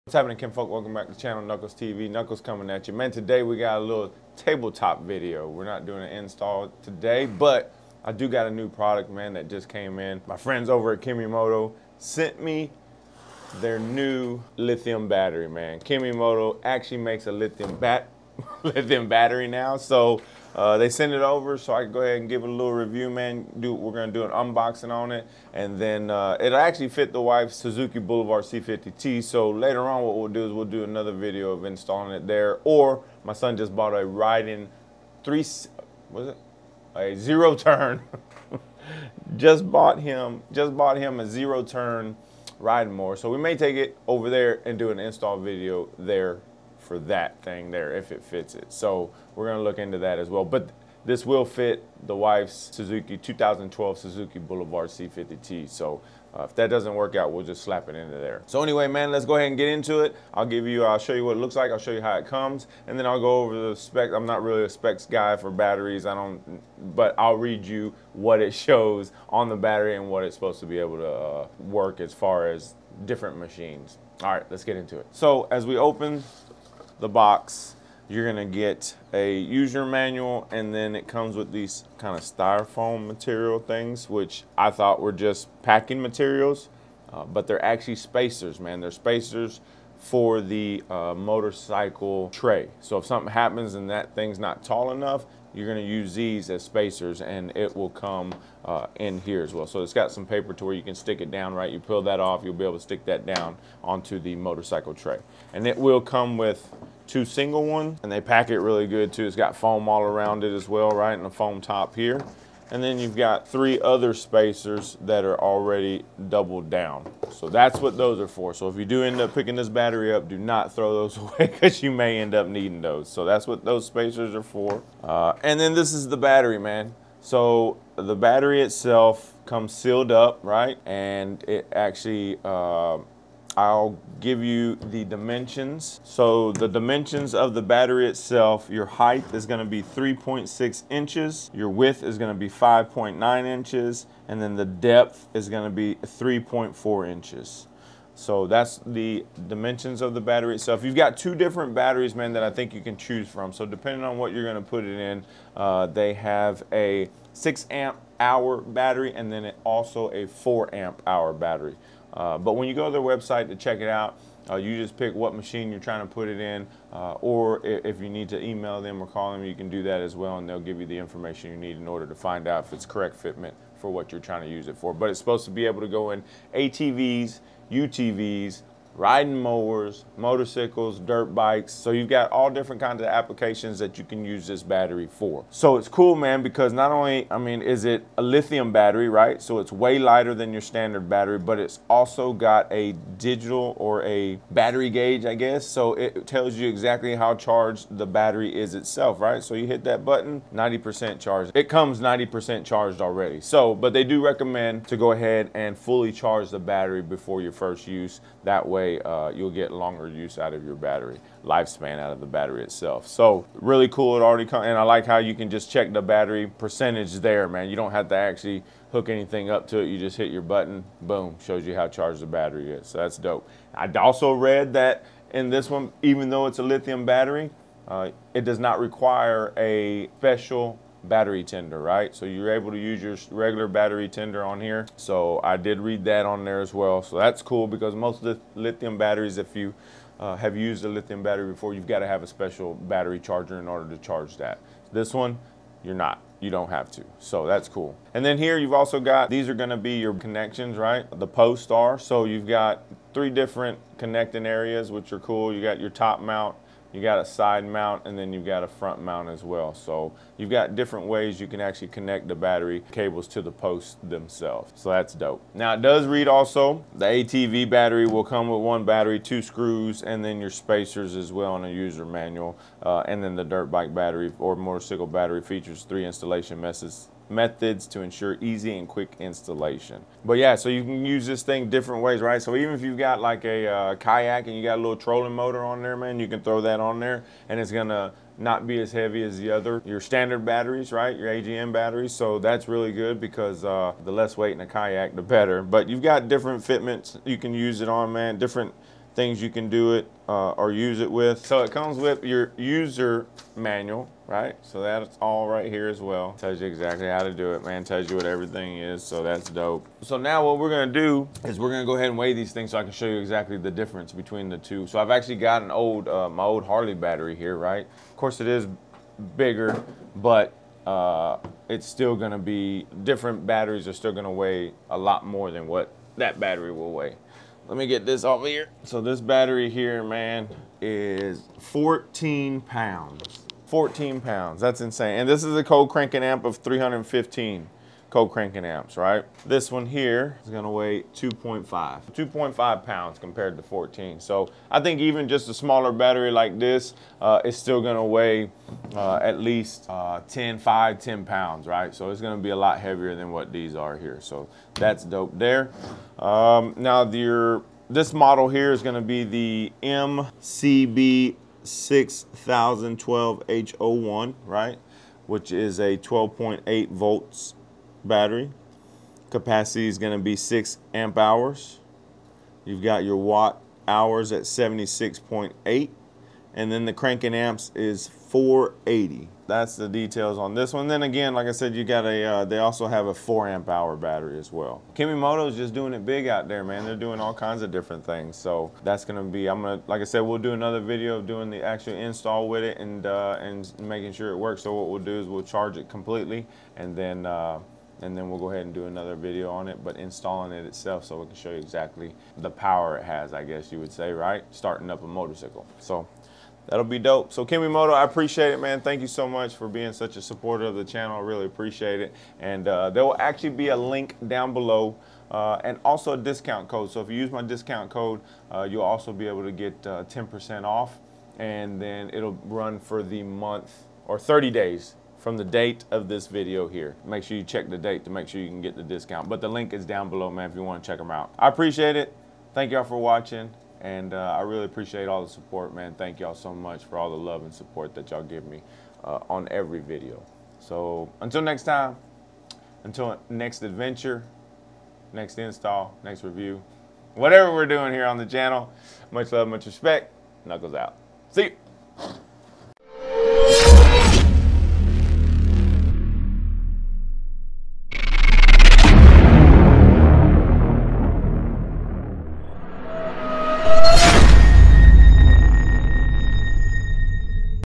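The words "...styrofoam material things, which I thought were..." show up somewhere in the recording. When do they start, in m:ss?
1:22.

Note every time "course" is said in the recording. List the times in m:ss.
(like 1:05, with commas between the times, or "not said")
5:18.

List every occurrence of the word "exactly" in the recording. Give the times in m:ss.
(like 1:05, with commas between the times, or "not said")
3:16, 5:06, 5:13, 6:41.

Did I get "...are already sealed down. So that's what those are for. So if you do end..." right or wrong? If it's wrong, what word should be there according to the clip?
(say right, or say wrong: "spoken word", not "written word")
wrong: "doubled", not "sealed".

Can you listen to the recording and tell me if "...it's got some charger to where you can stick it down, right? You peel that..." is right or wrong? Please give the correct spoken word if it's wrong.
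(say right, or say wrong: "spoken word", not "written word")
wrong: "paper", not "charger".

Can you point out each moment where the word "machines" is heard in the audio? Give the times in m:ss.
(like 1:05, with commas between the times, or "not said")
1:13, 2:45.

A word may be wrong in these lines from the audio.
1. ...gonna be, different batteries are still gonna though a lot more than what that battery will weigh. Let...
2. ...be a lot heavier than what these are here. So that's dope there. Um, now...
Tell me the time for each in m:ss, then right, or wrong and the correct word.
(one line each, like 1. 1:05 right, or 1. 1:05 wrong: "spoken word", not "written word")
1. 5:22 wrong: "weigh", not "though"
2. 5:52 right.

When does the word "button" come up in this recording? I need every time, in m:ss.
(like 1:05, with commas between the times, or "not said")
3:20, 3:40.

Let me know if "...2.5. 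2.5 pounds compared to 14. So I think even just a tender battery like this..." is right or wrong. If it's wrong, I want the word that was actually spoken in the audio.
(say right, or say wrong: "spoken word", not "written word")
wrong: "smaller", not "tender".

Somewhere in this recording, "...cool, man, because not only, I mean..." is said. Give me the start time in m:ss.
3:05.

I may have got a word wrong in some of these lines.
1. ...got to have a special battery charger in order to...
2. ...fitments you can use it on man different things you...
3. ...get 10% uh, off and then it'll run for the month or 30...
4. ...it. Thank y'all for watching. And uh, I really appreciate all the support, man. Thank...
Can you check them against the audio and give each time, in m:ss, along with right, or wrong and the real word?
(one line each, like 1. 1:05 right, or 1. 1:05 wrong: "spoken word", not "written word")
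1. 4:01 right
2. 4:56 right
3. 6:59 right
4. 7:11 right.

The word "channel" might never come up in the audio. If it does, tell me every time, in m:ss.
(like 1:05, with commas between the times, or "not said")
0:01, 6:50, 7:28.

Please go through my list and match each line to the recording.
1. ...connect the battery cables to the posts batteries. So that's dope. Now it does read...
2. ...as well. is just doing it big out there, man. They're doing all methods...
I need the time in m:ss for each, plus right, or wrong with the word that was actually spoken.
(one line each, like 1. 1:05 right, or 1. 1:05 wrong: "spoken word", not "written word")
1. 4:21 wrong: "themselves", not "batteries"
2. 6:24 wrong: "kinds", not "methods".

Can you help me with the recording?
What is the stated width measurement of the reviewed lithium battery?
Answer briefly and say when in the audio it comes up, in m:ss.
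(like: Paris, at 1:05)
5.9 inches, at 2:22.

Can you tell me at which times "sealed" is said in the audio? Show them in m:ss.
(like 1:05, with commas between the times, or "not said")
2:09.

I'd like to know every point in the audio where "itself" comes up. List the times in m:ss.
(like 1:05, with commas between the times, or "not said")
2:08, 2:18, 2:30, 3:18, 3:32, 6:40.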